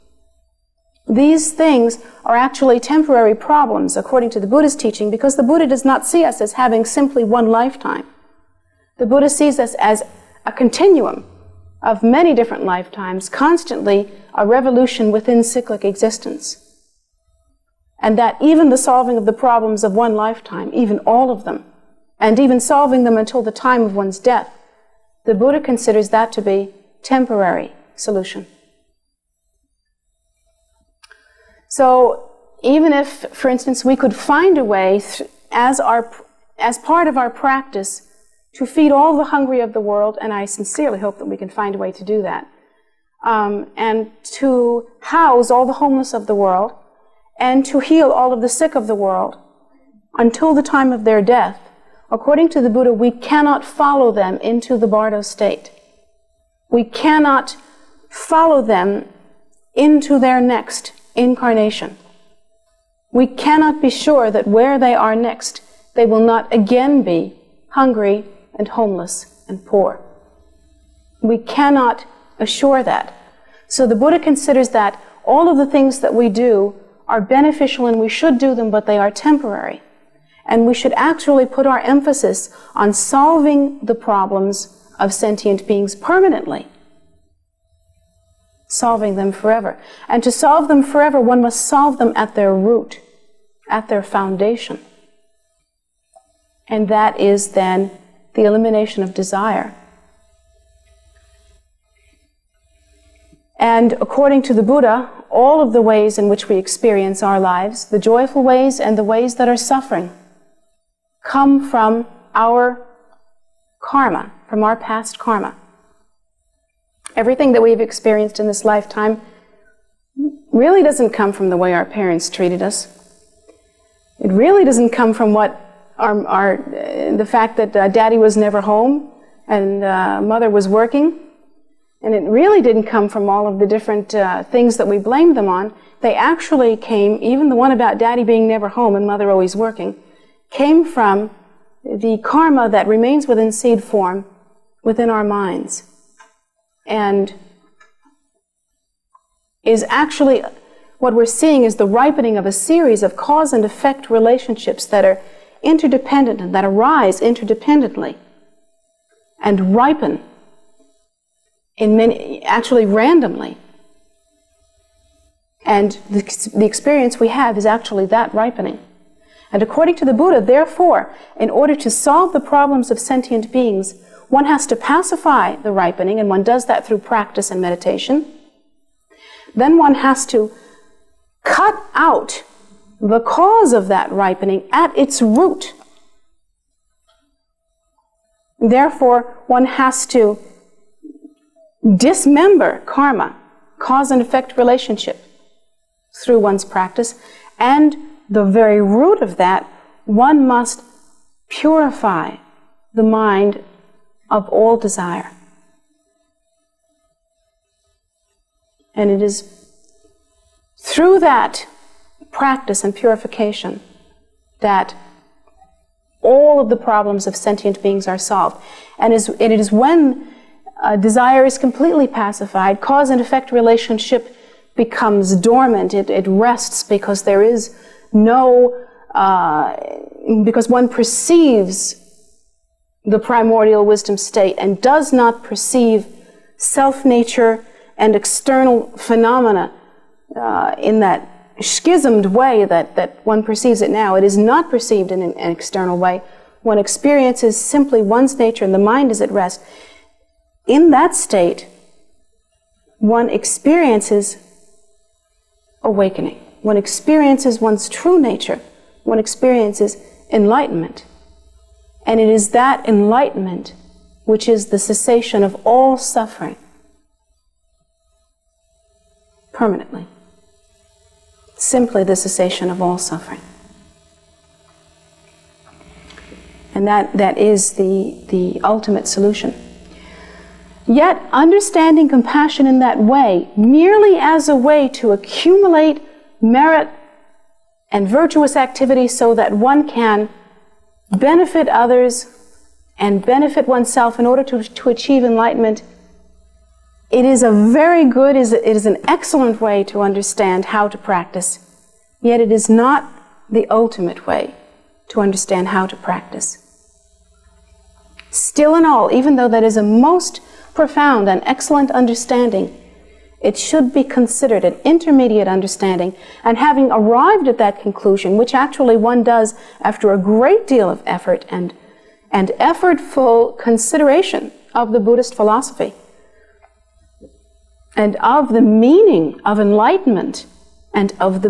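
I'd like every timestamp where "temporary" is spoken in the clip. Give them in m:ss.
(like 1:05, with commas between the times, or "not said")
0:02, 0:27, 1:19.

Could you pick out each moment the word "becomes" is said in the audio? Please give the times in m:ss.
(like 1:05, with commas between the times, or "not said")
3:44.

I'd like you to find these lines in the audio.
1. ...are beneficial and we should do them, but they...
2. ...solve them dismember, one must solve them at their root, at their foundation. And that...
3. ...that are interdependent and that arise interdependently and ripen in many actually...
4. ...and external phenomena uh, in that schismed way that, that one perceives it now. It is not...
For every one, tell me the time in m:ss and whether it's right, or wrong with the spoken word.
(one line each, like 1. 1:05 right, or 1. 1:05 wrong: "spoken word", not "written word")
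1. 1:17 right
2. 1:30 wrong: "forever", not "dismember"
3. 2:34 right
4. 3:57 right.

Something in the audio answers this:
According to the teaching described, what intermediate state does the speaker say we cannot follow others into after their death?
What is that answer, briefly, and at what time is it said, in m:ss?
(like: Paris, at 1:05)
Bardo state, at 0:54.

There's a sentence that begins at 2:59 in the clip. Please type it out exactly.
Then one has to cut out the cause of that ripening at its root.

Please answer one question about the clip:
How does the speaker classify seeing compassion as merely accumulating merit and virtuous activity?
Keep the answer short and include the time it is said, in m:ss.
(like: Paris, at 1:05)
intermediate understanding, at 5:14.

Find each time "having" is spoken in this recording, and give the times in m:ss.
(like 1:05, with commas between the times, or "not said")
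0:06, 5:16.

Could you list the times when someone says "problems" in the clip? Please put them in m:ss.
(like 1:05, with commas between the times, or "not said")
0:03, 0:19, 1:23, 2:52, 3:36.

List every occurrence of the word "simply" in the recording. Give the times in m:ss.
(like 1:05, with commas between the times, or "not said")
0:06, 4:07, 4:31.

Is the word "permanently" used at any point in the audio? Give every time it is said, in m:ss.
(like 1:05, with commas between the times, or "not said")
1:25, 4:29.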